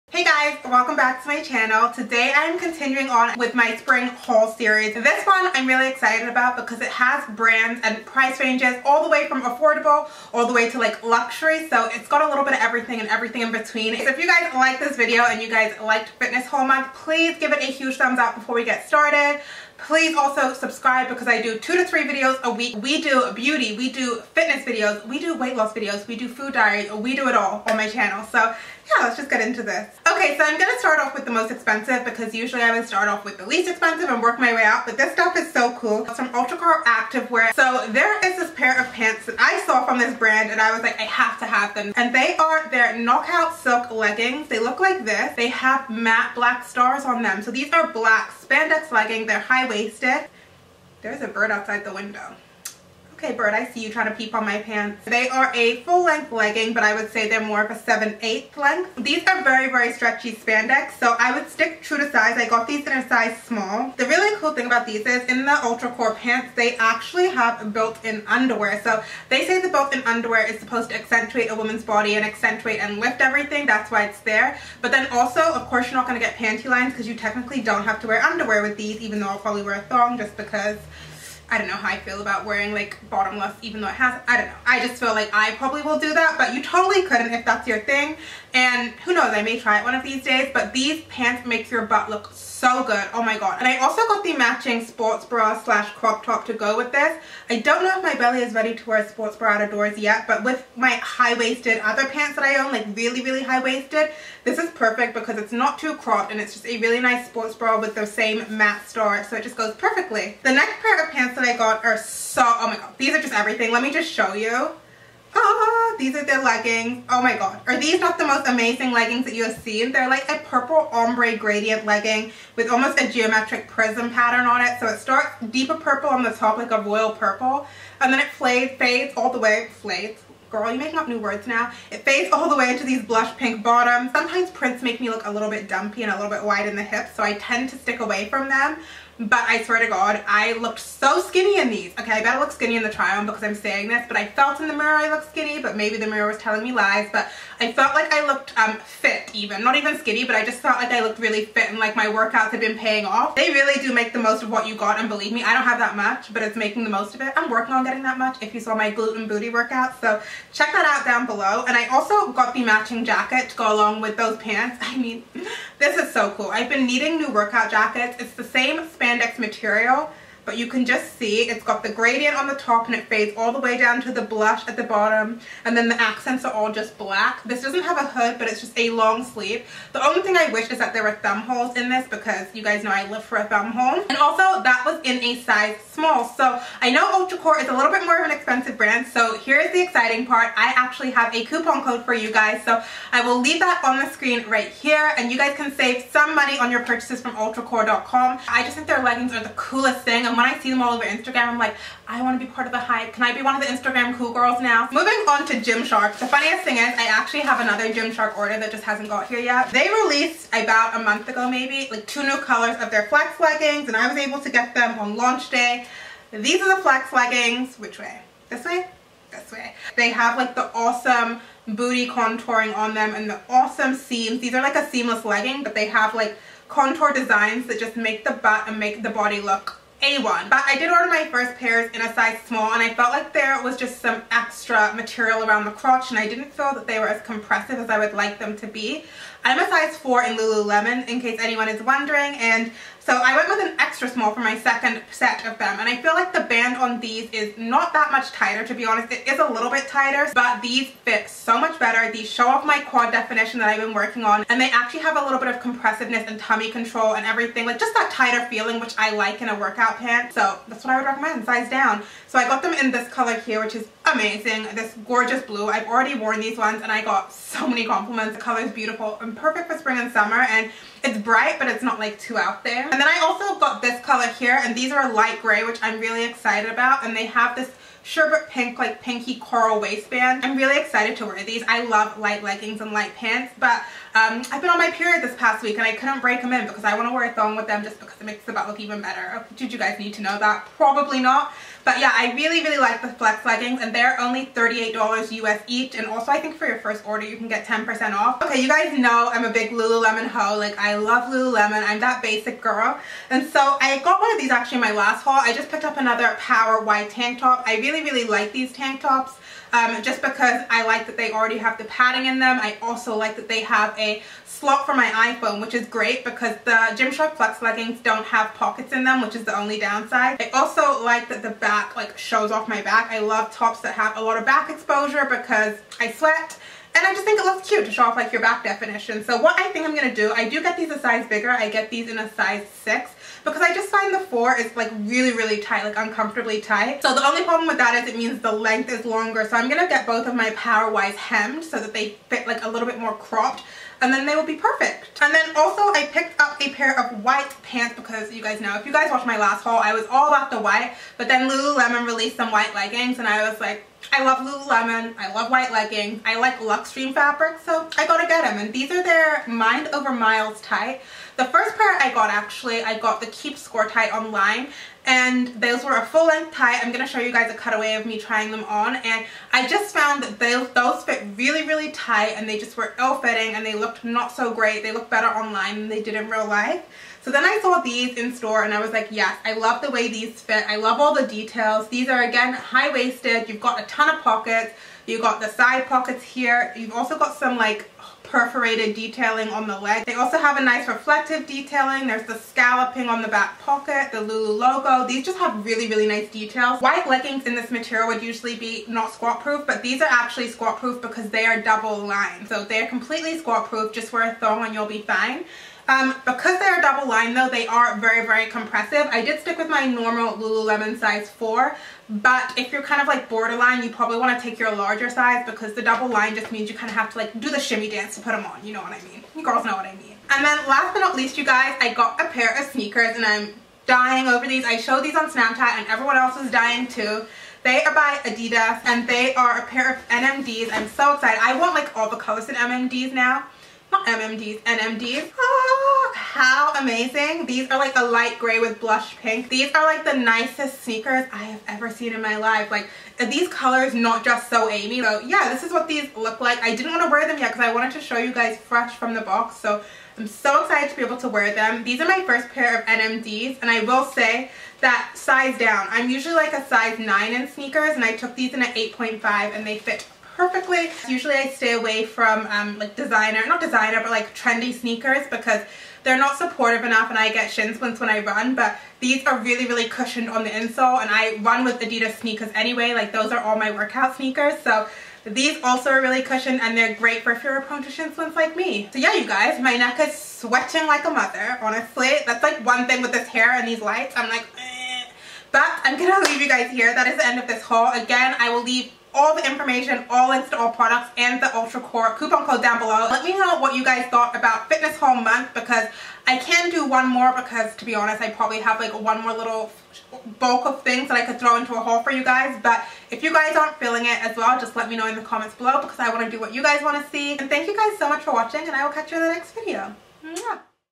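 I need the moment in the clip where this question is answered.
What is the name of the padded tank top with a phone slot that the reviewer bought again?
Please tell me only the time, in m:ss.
5:06.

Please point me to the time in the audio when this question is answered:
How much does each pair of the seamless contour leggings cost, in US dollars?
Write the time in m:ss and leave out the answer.
4:54.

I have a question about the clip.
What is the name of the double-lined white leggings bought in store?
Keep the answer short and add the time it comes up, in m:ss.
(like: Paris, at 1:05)
Mind Over Miles tight, at 5:59.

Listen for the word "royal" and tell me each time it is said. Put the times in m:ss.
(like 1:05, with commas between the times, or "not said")
2:06.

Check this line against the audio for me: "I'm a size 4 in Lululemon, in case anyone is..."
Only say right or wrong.
right.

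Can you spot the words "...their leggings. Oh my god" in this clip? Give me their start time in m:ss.
1:56.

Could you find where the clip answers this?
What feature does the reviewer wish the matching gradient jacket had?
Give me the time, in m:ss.
3:01.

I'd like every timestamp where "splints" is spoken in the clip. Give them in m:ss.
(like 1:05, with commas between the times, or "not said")
7:47, 7:58.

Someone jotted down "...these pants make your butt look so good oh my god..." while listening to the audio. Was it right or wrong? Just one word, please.
right.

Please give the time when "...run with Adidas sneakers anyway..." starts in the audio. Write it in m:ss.
7:51.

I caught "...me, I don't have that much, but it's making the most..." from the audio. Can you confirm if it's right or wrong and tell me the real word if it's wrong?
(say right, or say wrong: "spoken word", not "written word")
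right.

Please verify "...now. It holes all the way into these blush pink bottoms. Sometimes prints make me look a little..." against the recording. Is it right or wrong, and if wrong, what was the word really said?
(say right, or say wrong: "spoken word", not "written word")
wrong: "fades", not "holes".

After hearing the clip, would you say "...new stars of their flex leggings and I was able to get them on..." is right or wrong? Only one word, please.
wrong.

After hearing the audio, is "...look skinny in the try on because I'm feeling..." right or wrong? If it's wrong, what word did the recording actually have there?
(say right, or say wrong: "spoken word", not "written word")
wrong: "saying", not "feeling".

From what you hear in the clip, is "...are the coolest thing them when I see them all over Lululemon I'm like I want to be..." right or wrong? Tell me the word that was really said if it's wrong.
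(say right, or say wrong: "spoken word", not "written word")
wrong: "Instagram", not "Lululemon".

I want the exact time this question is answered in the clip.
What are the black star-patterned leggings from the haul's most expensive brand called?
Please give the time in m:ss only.
0:42.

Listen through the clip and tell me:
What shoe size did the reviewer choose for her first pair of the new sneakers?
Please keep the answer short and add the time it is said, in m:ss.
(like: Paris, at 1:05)
8.5, at 7:38.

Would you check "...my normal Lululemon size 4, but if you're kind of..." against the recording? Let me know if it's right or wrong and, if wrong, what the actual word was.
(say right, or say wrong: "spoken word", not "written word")
right.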